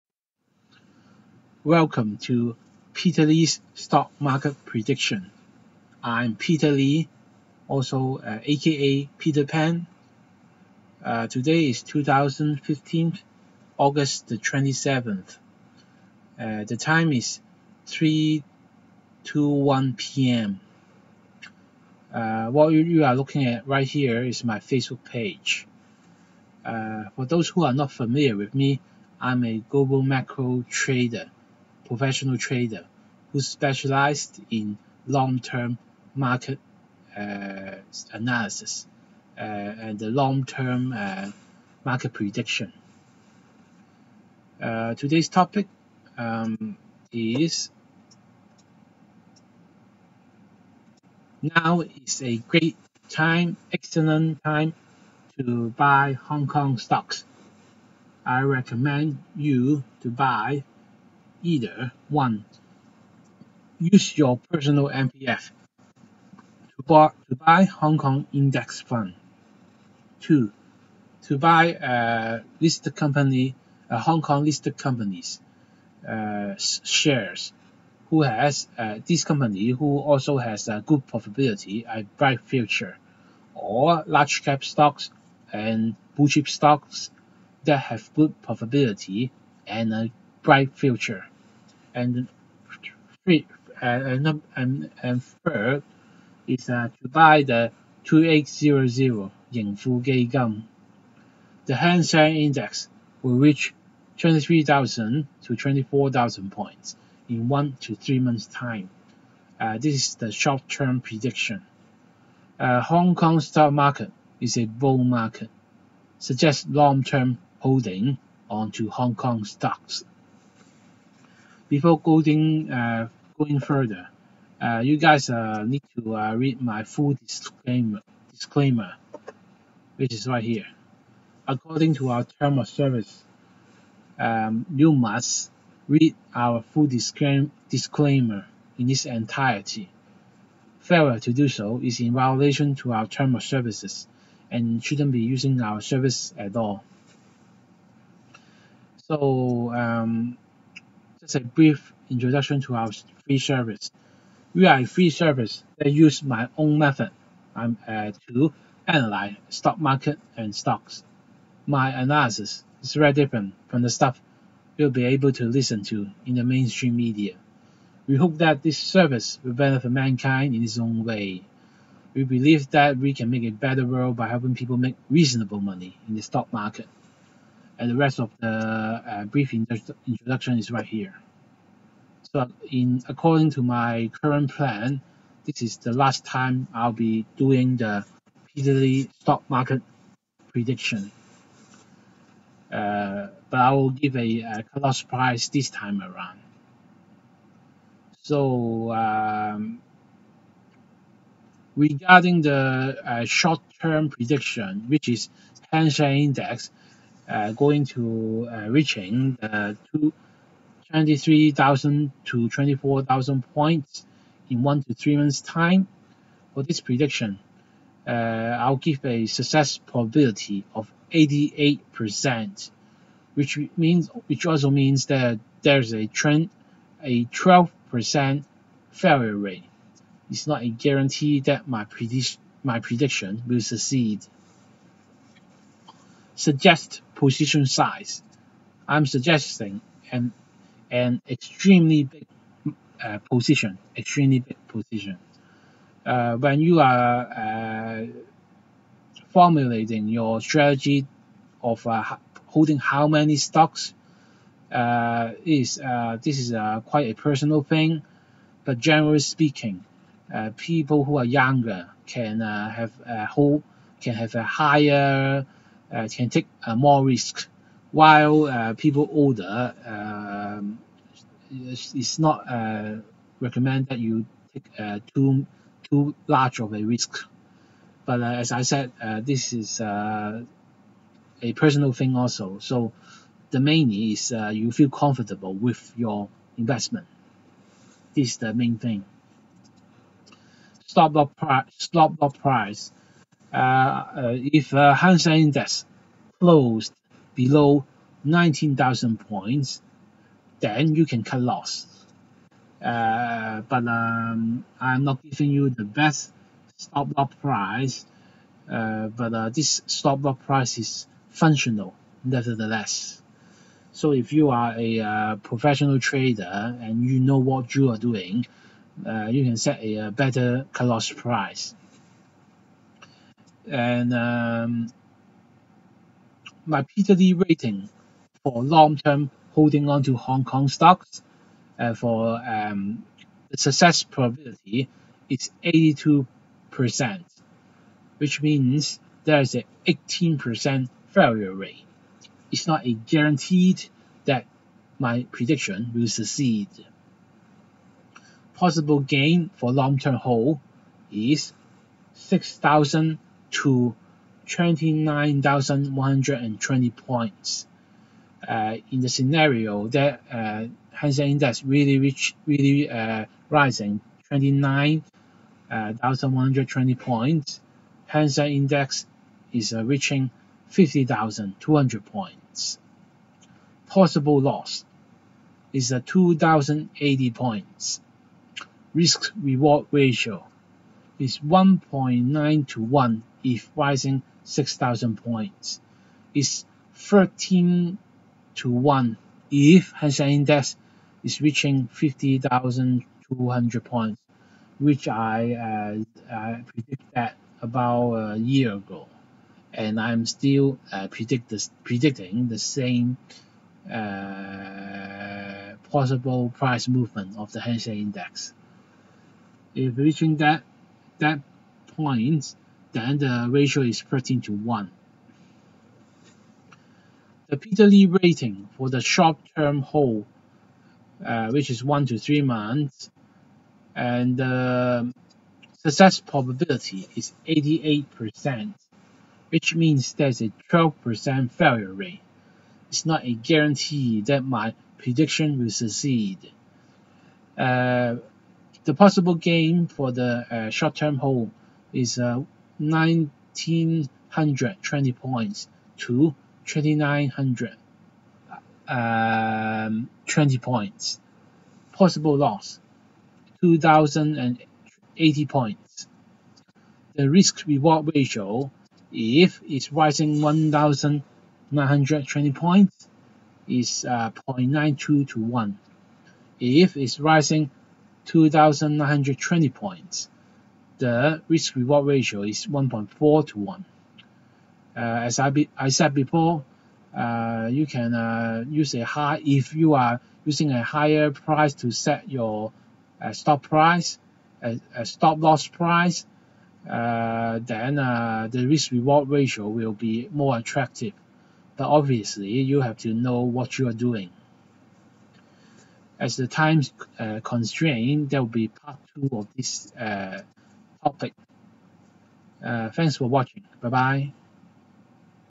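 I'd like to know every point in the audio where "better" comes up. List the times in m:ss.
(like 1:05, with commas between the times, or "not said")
2:53, 5:20.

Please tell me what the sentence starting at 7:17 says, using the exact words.
Uh, the possible gain for the uh, short-term hold is 1,920 uh, points to 2,900 um, 20 points.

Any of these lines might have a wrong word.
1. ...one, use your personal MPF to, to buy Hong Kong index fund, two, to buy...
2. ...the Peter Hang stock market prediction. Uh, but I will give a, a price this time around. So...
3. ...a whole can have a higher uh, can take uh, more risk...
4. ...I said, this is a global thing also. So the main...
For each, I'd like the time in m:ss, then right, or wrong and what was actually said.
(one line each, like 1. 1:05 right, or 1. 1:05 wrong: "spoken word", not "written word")
1. 1:02 right
2. 3:07 wrong: "Lee", not "Hang"
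3. 4:23 right
4. 4:38 wrong: "personal", not "global".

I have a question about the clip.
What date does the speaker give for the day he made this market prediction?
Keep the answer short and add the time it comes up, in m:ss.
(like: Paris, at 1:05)
2015, August 27, at 0:11.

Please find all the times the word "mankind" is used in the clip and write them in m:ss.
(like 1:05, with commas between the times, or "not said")
2:49.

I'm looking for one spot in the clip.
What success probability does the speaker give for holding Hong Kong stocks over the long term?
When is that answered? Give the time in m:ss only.
5:35.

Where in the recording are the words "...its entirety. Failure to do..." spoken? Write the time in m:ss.
2:18.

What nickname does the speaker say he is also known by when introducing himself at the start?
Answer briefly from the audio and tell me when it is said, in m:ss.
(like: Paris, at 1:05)
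Peter Pan, at 0:09.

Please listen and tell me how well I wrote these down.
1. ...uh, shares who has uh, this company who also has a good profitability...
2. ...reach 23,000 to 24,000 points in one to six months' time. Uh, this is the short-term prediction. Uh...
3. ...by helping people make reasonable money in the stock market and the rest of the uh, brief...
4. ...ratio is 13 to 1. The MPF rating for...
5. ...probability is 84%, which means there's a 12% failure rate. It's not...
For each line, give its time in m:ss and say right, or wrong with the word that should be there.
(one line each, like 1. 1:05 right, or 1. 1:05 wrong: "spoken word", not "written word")
1. 1:16 right
2. 1:43 wrong: "three", not "six"
3. 2:54 right
4. 6:53 wrong: "Lee", not "MPF"
5. 7:06 wrong: "88", not "84".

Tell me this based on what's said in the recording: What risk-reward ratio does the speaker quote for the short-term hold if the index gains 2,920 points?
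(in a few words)
1.4 to 1.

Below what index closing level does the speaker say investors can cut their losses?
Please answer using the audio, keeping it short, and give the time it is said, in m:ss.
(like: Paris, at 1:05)
19,000 points, at 4:58.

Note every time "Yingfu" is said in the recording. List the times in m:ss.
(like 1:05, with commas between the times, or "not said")
1:39.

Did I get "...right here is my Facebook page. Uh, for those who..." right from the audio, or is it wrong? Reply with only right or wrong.
right.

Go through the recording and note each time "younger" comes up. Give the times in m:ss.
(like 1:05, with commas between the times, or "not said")
4:21.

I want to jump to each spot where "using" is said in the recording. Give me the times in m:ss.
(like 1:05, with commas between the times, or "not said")
2:25, 8:00.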